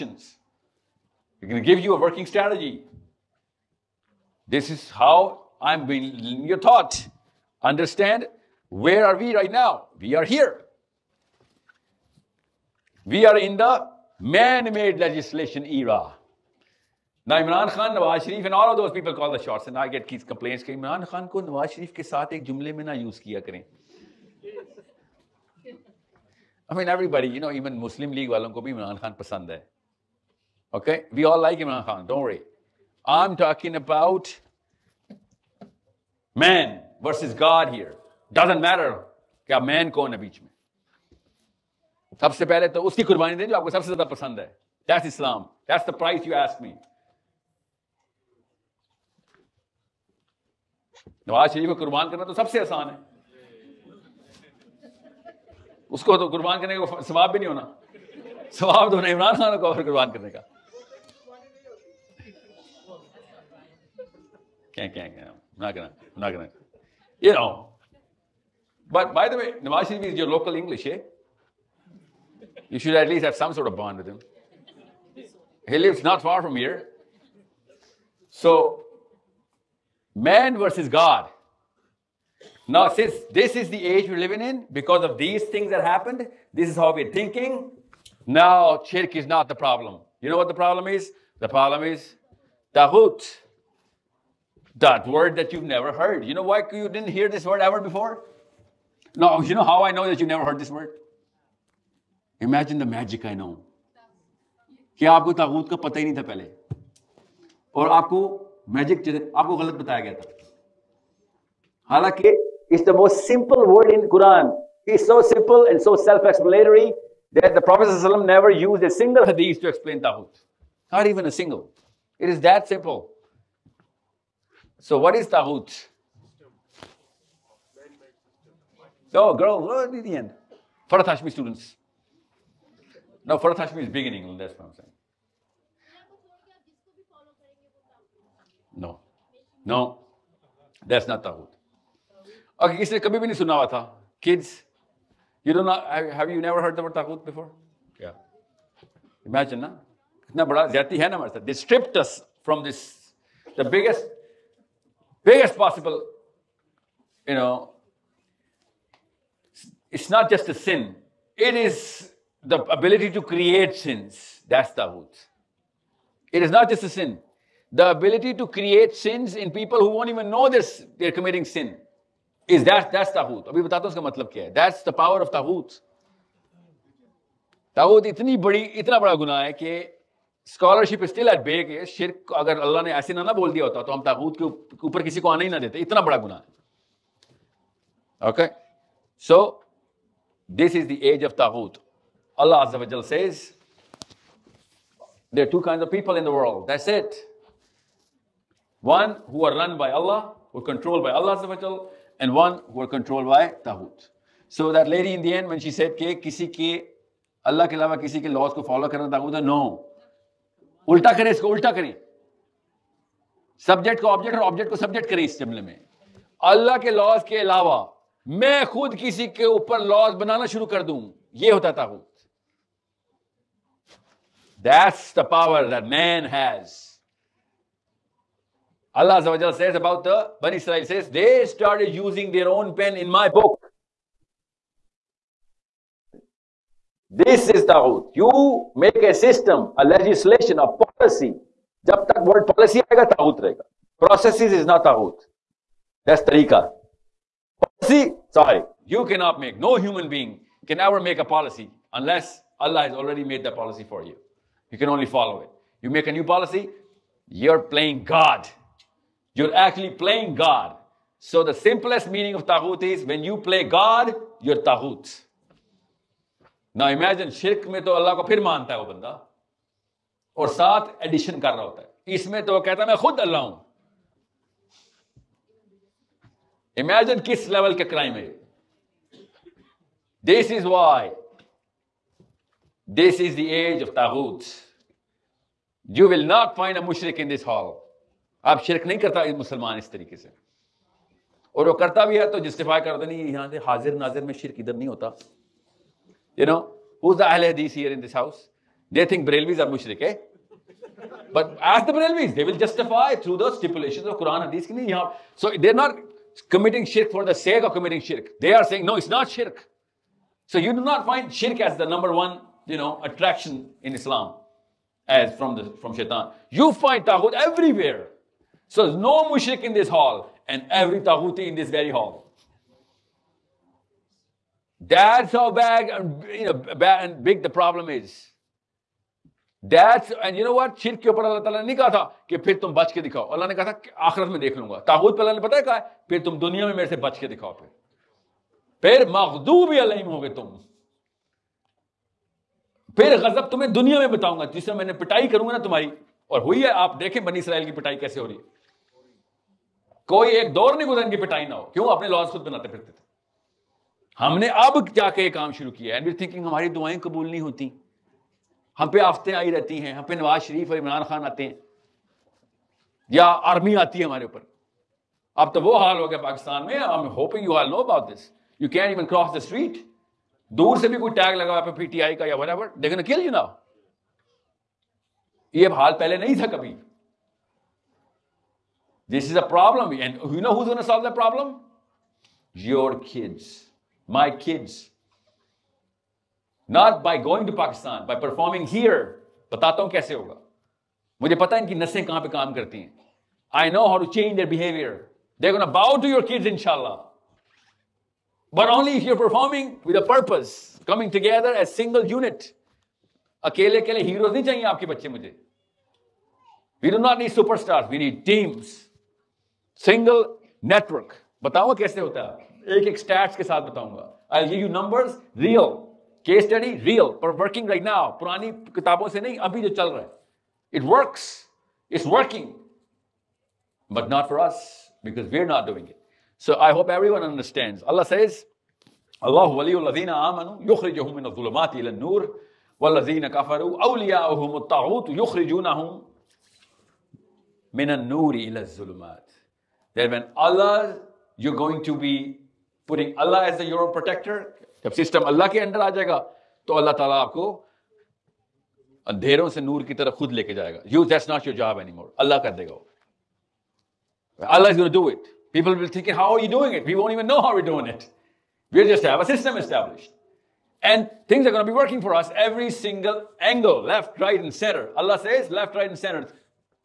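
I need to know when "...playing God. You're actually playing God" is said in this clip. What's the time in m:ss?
4:17.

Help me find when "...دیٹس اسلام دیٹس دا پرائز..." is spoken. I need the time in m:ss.
0:44.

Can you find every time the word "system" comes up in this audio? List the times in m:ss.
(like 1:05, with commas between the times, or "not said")
3:59, 7:24, 7:39.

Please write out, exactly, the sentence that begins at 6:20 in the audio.
And you know who's going to solve the problem?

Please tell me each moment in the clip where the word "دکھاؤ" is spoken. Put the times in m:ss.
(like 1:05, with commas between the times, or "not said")
5:33, 5:37.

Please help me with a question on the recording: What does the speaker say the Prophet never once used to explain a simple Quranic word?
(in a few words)
Hadith.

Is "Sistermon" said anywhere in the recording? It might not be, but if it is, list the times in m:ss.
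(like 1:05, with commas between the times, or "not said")
not said.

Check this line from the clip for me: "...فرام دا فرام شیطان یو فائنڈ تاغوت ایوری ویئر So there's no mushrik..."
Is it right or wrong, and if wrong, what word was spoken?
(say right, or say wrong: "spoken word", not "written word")
right.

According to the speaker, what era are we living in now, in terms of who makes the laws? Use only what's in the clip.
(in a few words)
Man-made legislation era.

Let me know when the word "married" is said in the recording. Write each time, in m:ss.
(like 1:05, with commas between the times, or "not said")
not said.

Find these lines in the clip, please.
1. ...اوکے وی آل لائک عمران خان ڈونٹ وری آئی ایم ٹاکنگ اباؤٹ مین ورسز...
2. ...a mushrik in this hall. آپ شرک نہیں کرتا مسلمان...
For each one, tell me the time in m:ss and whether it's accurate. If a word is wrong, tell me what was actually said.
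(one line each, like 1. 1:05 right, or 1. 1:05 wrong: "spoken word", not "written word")
1. 0:30 right
2. 4:46 right.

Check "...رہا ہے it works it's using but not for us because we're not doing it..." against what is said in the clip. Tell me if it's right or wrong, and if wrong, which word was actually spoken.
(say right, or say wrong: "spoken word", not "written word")
wrong: "working", not "using".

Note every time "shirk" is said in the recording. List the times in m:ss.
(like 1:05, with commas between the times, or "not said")
1:28, 4:27.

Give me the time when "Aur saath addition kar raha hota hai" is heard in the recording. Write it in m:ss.
4:30.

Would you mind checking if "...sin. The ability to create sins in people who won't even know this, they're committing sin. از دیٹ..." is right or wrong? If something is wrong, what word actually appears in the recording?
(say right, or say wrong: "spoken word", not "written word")
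right.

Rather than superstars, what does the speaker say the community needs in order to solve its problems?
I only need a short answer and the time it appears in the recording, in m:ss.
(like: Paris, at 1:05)
Teams, at 6:48.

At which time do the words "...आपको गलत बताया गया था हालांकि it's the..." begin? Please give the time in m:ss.
1:49.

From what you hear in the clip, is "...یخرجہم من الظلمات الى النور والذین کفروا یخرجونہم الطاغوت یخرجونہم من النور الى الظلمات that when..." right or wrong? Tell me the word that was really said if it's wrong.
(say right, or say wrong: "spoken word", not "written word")
wrong: "اولیاؤہم", not "یخرجونہم".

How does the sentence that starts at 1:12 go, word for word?
You should at least have some sort of bond with him.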